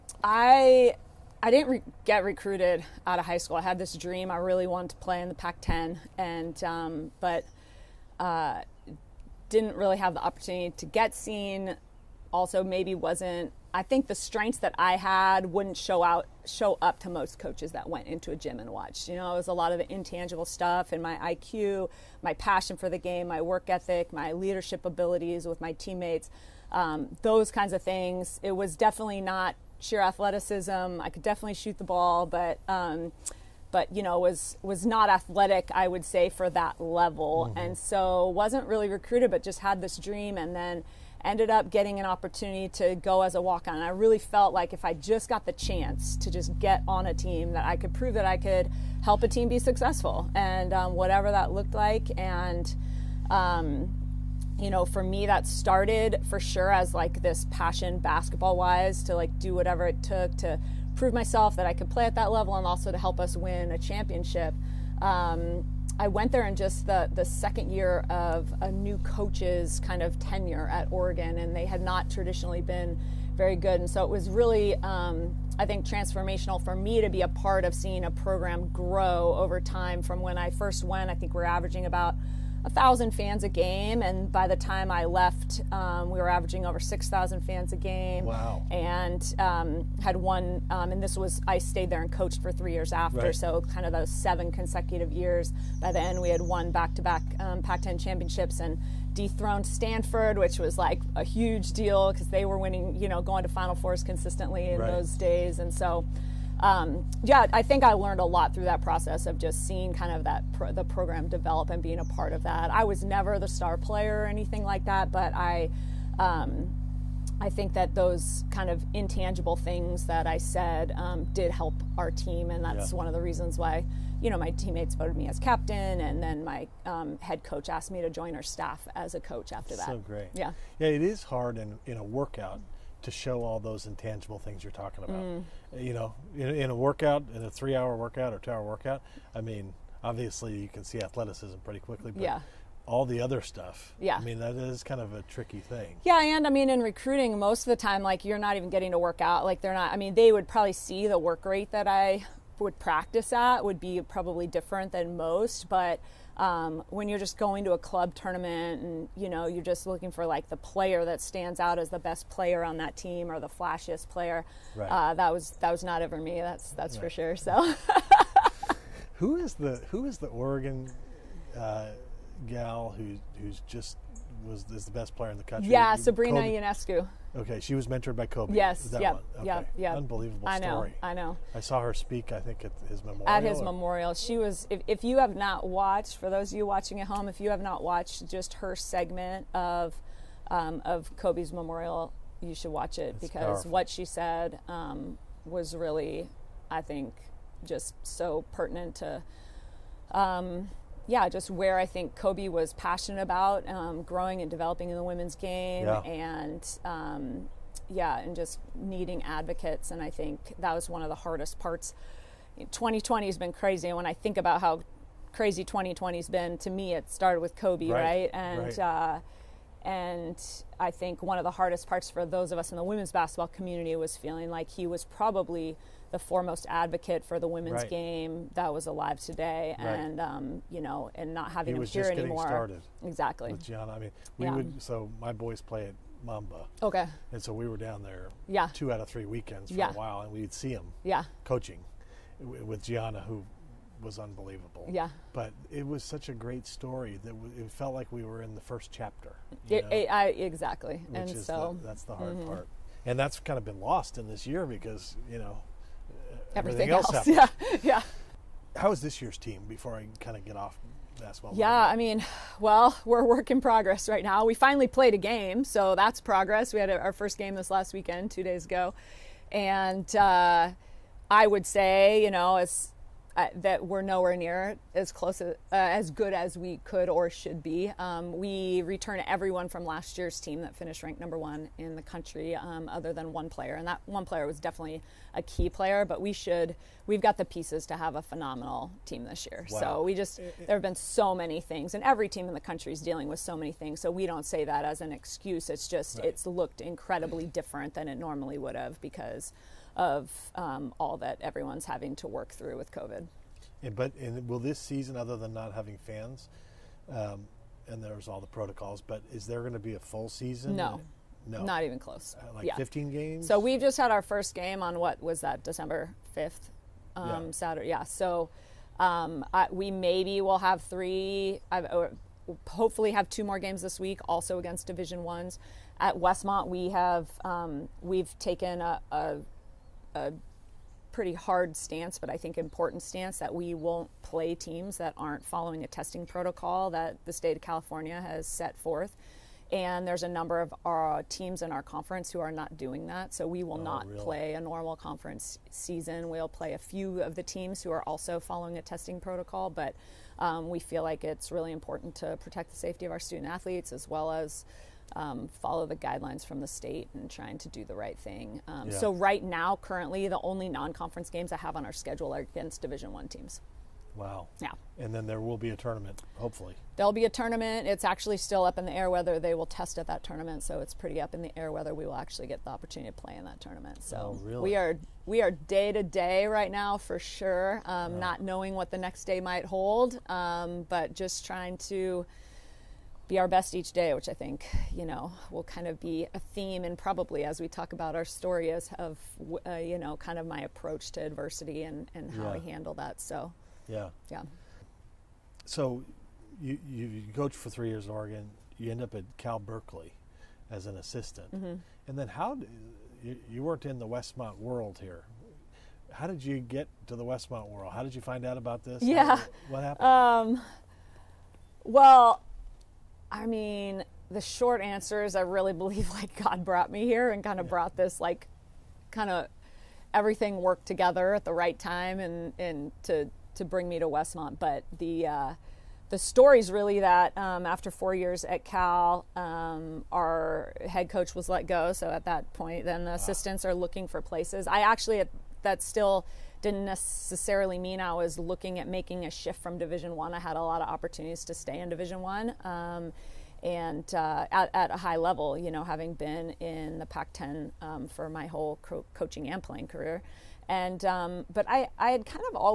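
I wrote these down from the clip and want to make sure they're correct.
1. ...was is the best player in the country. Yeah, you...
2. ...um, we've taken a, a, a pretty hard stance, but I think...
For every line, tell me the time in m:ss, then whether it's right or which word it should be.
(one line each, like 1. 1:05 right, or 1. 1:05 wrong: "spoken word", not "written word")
1. 2:54 right
2. 5:27 right.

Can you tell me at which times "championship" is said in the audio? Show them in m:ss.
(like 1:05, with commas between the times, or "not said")
1:03, 1:37.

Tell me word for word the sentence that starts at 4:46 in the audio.
But we should we've got the pieces to have a phenomenal team this year.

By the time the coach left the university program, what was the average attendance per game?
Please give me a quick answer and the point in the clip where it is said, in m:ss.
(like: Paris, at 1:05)
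over 6000, at 1:26.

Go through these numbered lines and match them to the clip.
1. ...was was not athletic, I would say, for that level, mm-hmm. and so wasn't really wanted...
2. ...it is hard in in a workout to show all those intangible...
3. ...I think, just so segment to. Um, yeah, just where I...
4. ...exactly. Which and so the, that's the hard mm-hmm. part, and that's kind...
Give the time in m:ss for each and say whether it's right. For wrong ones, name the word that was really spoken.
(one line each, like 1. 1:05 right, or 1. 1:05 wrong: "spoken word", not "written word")
1. 0:34 wrong: "recruited", not "wanted"
2. 2:10 right
3. 3:16 wrong: "pertinent", not "segment"
4. 4:10 right.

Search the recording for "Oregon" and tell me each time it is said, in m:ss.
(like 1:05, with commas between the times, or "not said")
1:10, 2:50, 6:38.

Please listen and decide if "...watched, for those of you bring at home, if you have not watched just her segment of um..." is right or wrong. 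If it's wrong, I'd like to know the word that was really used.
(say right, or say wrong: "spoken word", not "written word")
wrong: "watching", not "bring".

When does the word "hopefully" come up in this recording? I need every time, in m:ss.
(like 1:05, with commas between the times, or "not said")
5:22, 6:06.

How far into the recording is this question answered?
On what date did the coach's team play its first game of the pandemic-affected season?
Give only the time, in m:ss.
5:15.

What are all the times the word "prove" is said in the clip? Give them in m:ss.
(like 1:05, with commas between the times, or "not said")
0:47, 1:00.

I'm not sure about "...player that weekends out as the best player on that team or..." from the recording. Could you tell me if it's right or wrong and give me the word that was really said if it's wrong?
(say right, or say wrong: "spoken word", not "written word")
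wrong: "stands", not "weekends".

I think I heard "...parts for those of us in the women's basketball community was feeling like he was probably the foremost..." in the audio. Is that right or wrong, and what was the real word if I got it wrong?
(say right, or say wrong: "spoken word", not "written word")
right.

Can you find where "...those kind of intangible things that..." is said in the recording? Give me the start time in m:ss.
1:57.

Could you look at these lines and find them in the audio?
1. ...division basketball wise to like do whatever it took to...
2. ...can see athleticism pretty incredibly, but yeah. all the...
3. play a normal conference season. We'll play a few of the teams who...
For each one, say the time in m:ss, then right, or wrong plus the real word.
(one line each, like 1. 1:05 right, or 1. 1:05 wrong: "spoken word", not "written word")
1. 0:57 wrong: "passion", not "division"
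2. 2:20 wrong: "quickly", not "incredibly"
3. 5:44 right.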